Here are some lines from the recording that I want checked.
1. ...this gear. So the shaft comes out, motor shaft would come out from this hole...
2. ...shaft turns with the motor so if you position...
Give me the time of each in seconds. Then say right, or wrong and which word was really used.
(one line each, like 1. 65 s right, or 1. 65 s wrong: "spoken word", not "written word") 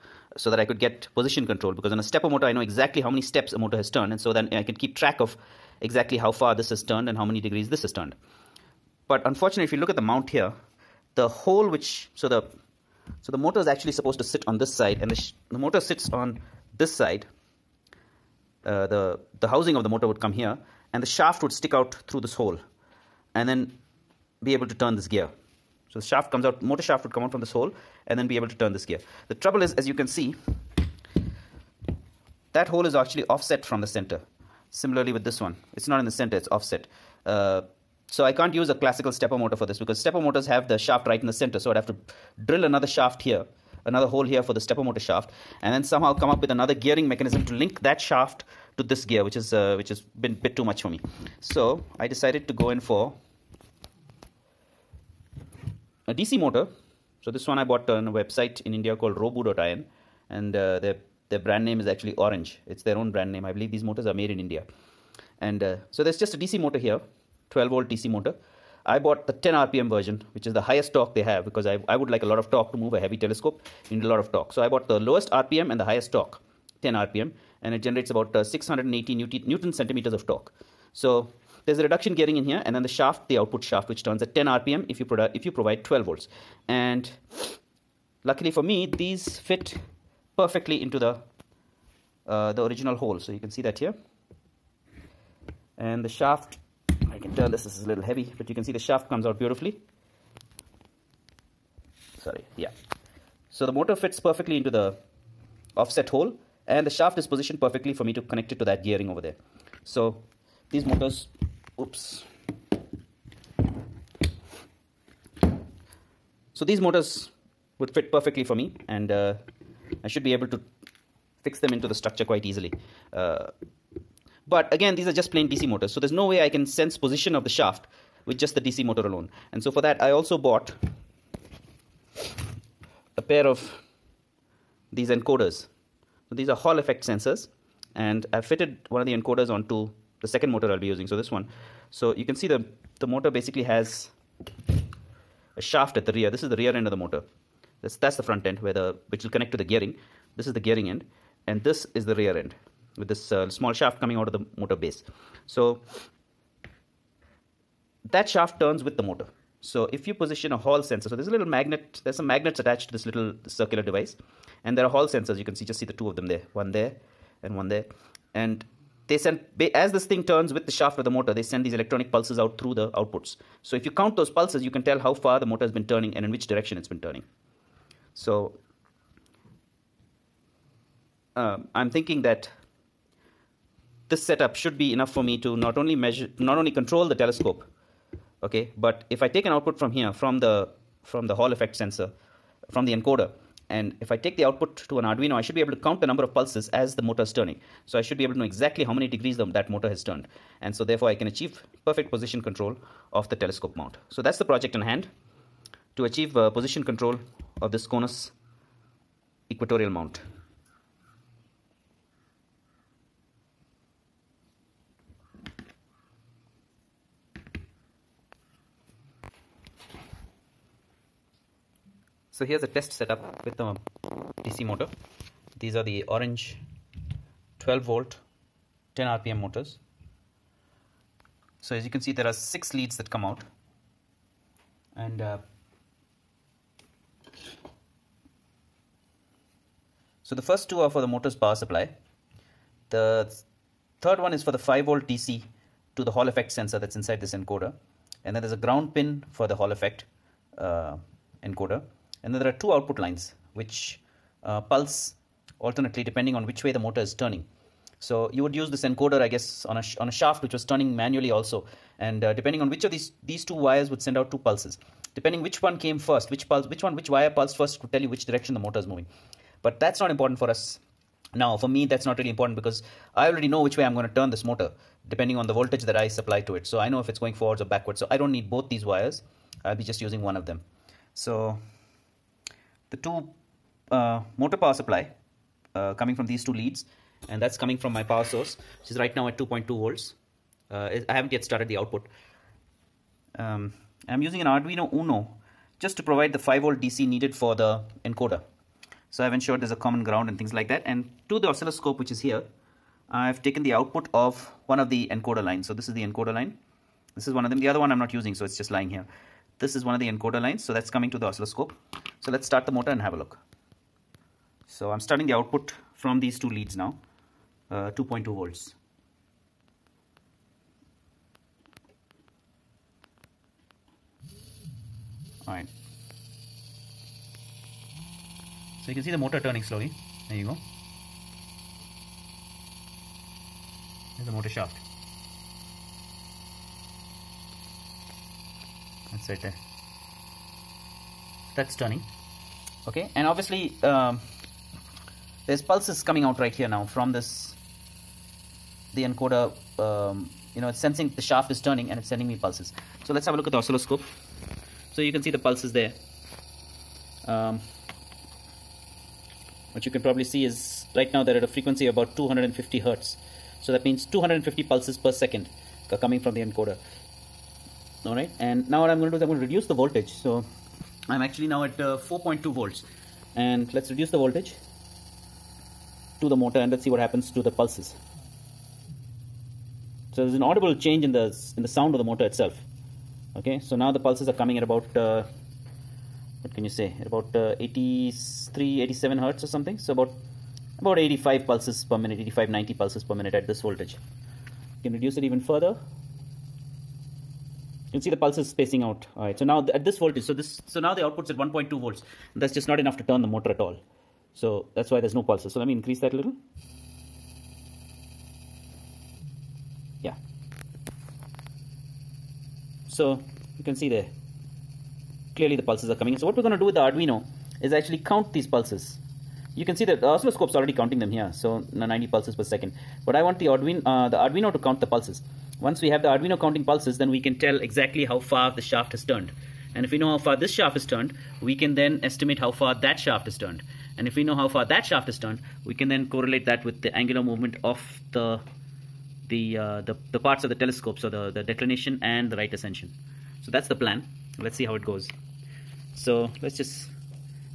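1. 24 s right
2. 158 s right.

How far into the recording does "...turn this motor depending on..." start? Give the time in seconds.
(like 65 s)
274 s.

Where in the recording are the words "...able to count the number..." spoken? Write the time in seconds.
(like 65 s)
195 s.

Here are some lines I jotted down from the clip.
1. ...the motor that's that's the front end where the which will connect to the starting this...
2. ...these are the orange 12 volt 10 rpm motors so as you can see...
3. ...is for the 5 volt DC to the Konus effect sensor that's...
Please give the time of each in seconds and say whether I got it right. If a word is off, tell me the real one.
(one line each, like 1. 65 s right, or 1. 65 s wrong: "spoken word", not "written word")
1. 146 s wrong: "gearing", not "starting"
2. 225 s right
3. 244 s wrong: "Hall", not "Konus".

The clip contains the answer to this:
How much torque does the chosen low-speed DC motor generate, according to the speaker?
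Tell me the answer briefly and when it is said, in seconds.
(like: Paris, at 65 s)
680 newton centimeters, at 78 s.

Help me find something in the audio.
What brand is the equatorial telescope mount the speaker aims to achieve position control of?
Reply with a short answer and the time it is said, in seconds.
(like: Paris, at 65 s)
Konus, at 207 s.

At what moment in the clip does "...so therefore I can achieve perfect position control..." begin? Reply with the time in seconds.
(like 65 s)
200 s.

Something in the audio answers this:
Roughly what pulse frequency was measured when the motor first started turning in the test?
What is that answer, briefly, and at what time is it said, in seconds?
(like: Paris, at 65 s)
250 hertz, at 362 s.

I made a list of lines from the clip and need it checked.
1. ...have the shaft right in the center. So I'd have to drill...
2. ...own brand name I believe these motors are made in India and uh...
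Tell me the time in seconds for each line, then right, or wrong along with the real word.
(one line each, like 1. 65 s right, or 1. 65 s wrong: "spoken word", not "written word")
1. 40 s right
2. 62 s right.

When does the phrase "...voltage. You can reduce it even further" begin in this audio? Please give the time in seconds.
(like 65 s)
393 s.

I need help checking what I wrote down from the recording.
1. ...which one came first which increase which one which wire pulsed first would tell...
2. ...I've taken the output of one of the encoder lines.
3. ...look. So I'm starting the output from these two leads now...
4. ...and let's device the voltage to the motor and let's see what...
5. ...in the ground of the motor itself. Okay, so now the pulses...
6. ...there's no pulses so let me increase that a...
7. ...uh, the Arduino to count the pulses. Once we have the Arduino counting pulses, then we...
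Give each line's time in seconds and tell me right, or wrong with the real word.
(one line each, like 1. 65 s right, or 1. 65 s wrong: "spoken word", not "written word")
1. 265 s wrong: "pulse", not "increase"
2. 303 s right
3. 313 s right
4. 373 s wrong: "reduce", not "device"
5. 381 s wrong: "sound", not "ground"
6. 404 s right
7. 423 s right.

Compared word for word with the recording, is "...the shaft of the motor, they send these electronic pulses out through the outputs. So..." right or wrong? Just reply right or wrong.
right.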